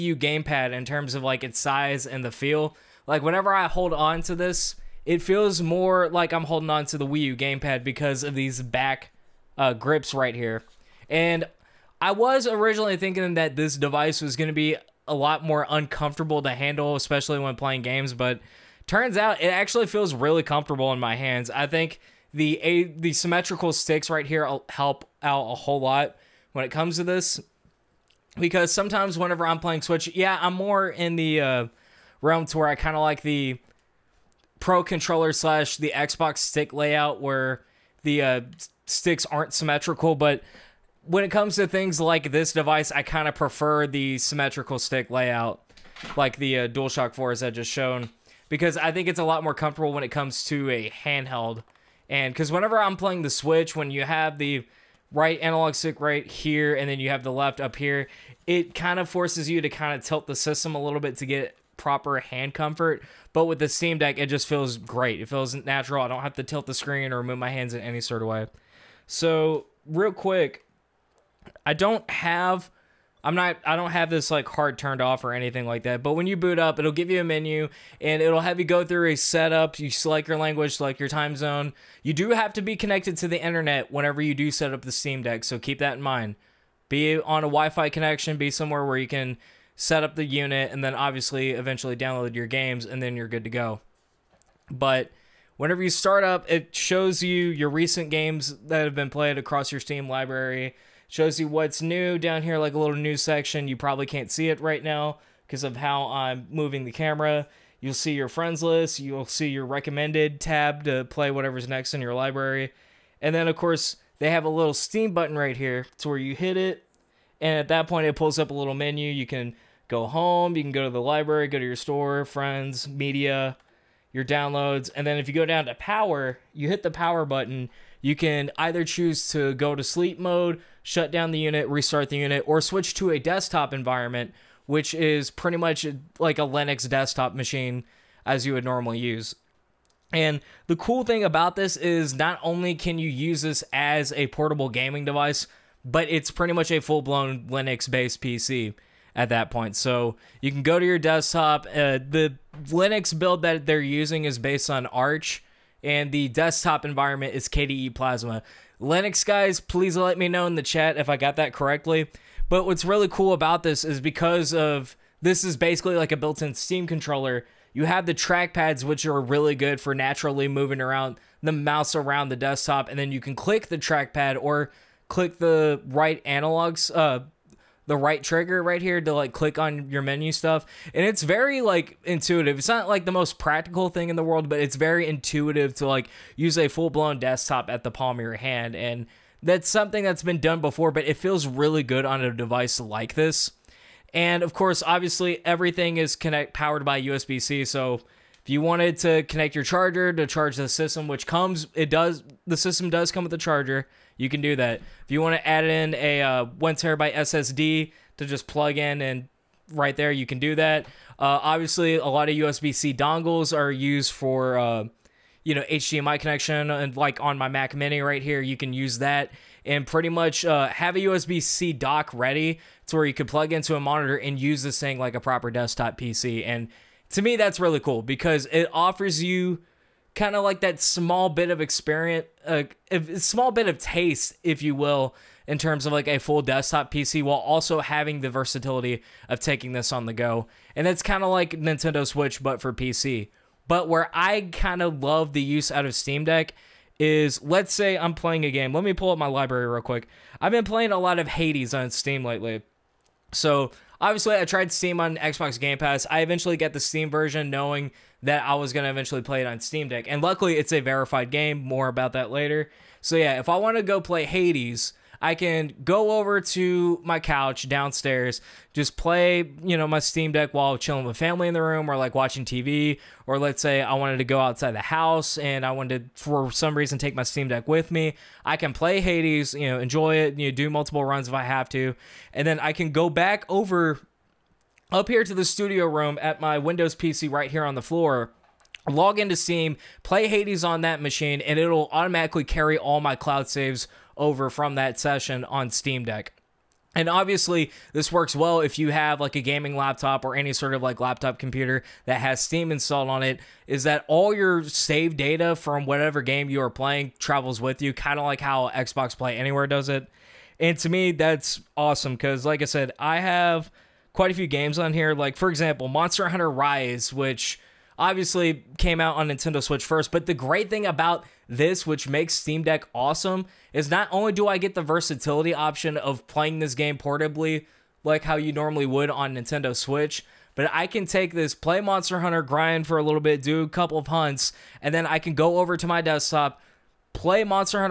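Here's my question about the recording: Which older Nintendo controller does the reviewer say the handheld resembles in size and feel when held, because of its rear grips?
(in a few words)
Wii U gamepad.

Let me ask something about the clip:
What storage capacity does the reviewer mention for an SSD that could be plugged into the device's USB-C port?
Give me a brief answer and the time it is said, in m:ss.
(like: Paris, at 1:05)
1 terabyte, at 3:26.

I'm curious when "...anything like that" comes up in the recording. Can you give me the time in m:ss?
1:15.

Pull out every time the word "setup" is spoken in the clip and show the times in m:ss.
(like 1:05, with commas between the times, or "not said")
1:19.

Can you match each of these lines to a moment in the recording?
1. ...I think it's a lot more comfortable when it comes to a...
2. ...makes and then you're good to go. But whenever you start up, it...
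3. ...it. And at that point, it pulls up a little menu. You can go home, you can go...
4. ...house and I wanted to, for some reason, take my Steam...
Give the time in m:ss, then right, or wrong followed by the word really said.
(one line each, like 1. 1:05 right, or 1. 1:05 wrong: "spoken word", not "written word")
1. 0:48 right
2. 1:32 wrong: "games", not "makes"
3. 1:56 right
4. 4:34 right.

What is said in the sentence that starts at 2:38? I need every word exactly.
Linux guys, please let me know in the chat if I got that correctly.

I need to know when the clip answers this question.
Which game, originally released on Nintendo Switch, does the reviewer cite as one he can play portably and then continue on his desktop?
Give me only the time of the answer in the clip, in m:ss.
5:15.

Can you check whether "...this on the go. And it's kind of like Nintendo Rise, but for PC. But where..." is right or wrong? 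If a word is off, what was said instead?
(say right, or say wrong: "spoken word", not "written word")
wrong: "Switch", not "Rise".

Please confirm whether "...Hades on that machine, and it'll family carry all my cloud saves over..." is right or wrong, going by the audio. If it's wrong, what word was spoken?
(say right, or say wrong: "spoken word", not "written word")
wrong: "automatically", not "family".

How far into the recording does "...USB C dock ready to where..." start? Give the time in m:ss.
3:41.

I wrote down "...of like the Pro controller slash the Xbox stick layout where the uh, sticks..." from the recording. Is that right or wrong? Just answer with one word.
right.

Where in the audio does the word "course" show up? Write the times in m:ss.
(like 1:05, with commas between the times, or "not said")
1:53, 3:14.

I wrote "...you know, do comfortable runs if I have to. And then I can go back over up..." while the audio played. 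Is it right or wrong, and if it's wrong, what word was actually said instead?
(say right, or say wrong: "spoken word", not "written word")
wrong: "multiple", not "comfortable".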